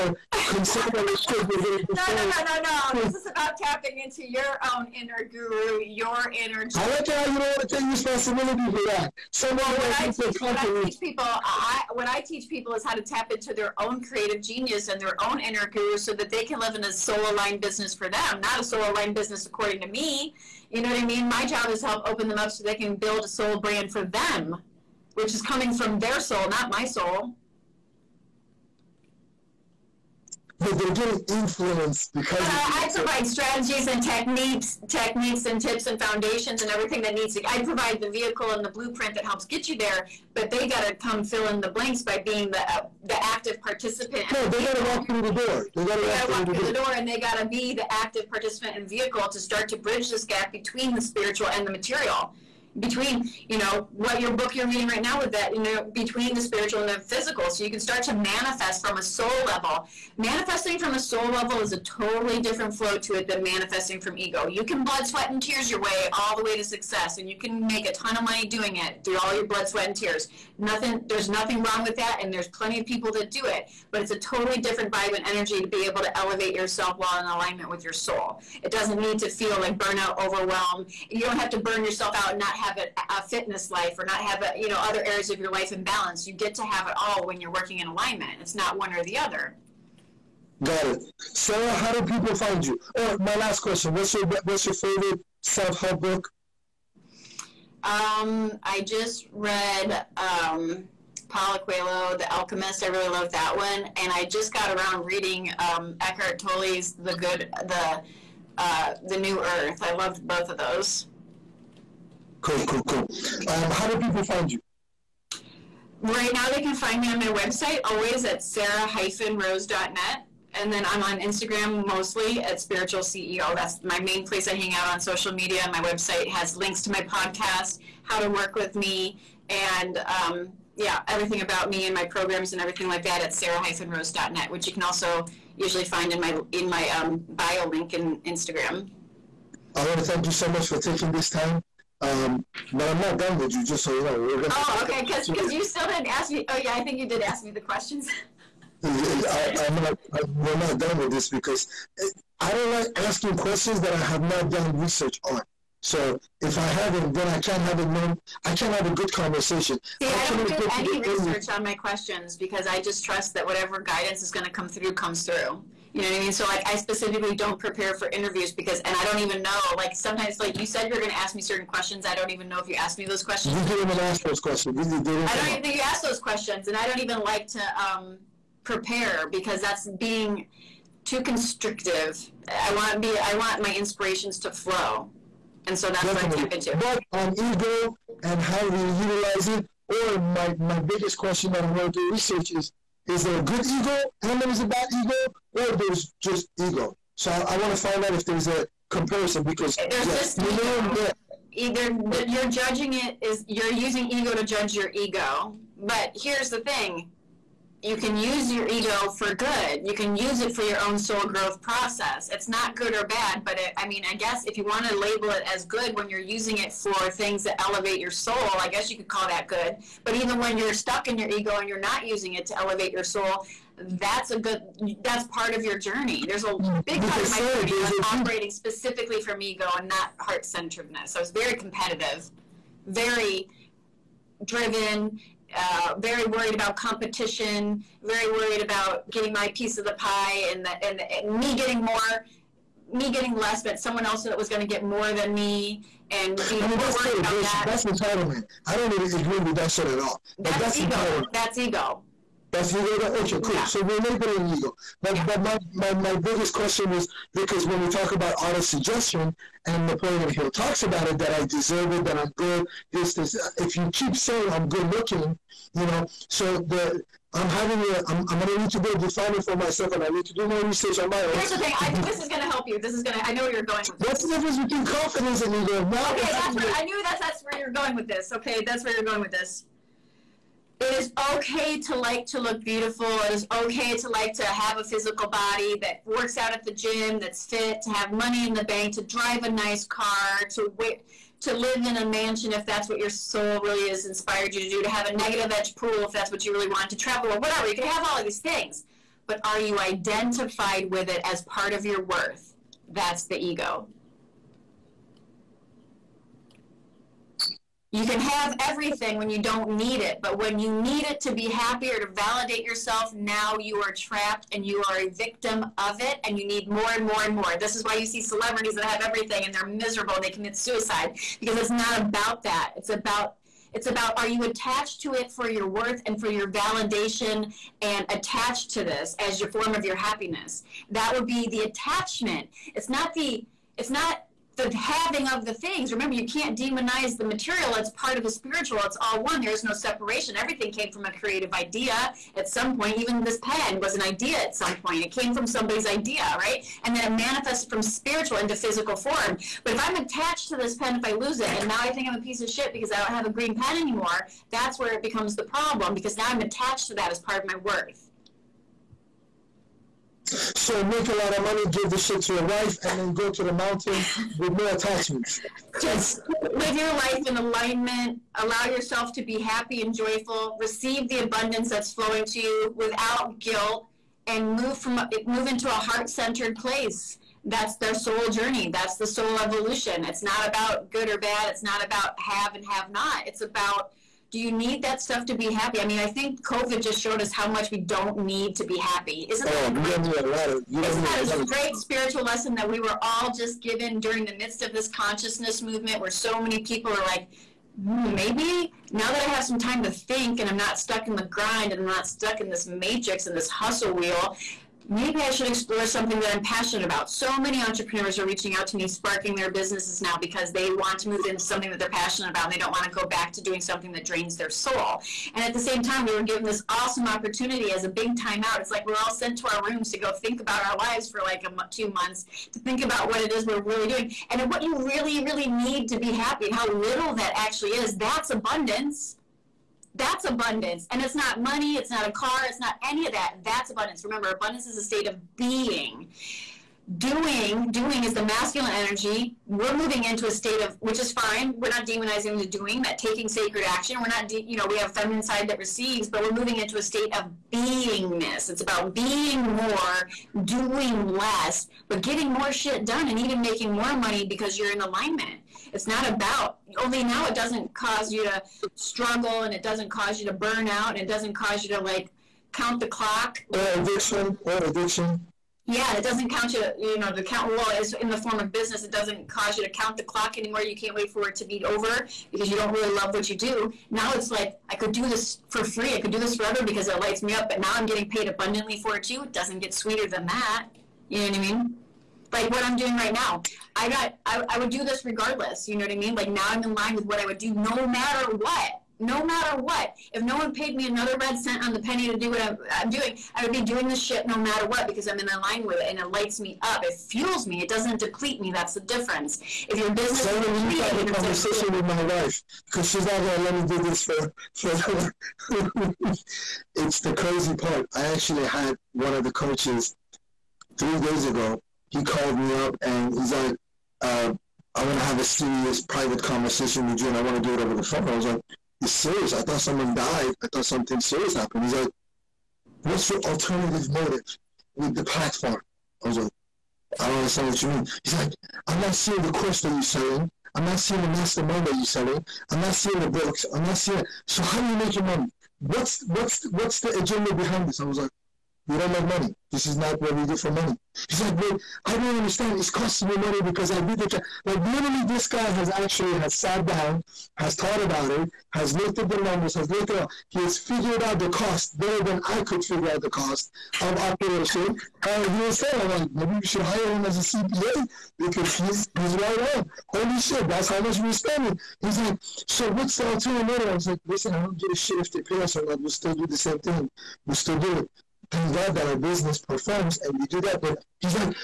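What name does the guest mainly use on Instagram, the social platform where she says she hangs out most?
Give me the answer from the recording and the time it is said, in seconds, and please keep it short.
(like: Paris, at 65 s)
Spiritual CEO, at 122 s.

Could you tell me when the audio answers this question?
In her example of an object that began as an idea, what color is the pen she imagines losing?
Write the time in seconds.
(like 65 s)
353 s.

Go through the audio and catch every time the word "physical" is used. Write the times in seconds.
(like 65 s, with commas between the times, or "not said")
57 s, 284 s, 348 s.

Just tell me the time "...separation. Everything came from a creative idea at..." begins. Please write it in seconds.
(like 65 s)
339 s.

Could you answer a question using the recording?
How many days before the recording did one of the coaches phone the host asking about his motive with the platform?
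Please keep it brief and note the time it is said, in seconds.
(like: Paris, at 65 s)
3 days, at 510 s.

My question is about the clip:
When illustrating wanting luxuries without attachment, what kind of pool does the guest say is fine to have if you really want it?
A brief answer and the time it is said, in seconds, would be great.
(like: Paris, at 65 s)
negative edge pool, at 295 s.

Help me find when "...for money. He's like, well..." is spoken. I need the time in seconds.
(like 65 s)
540 s.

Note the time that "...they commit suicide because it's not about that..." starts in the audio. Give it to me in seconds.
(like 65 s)
320 s.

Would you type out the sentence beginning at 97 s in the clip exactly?
Um, I just read um Paulo Coelho, The Alchemist.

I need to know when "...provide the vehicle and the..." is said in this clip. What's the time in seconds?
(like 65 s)
37 s.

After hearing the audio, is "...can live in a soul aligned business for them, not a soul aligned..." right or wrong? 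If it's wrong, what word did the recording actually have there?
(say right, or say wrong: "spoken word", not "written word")
right.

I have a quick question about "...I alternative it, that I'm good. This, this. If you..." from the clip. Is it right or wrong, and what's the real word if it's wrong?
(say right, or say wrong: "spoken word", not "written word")
wrong: "deserve", not "alternative".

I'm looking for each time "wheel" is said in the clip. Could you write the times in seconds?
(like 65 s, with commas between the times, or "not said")
403 s.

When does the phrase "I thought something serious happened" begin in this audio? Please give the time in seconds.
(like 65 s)
520 s.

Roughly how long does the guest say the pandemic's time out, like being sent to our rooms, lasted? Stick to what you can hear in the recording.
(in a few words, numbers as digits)
2 months.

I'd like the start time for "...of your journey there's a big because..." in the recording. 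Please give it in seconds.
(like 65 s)
225 s.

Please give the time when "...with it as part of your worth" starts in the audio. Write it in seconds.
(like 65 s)
300 s.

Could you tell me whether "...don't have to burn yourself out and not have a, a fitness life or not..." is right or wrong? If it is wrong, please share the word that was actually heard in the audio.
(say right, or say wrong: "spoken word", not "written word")
right.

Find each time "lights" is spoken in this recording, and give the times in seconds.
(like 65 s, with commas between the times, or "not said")
476 s, 496 s.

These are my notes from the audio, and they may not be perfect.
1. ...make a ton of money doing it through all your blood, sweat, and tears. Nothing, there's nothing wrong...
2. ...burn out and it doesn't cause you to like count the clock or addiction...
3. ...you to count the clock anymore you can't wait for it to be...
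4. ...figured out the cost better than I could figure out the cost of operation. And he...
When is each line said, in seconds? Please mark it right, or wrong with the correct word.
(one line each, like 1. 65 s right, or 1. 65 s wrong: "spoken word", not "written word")
1. 67 s right
2. 460 s right
3. 469 s right
4. 550 s right.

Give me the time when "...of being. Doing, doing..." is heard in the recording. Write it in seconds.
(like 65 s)
435 s.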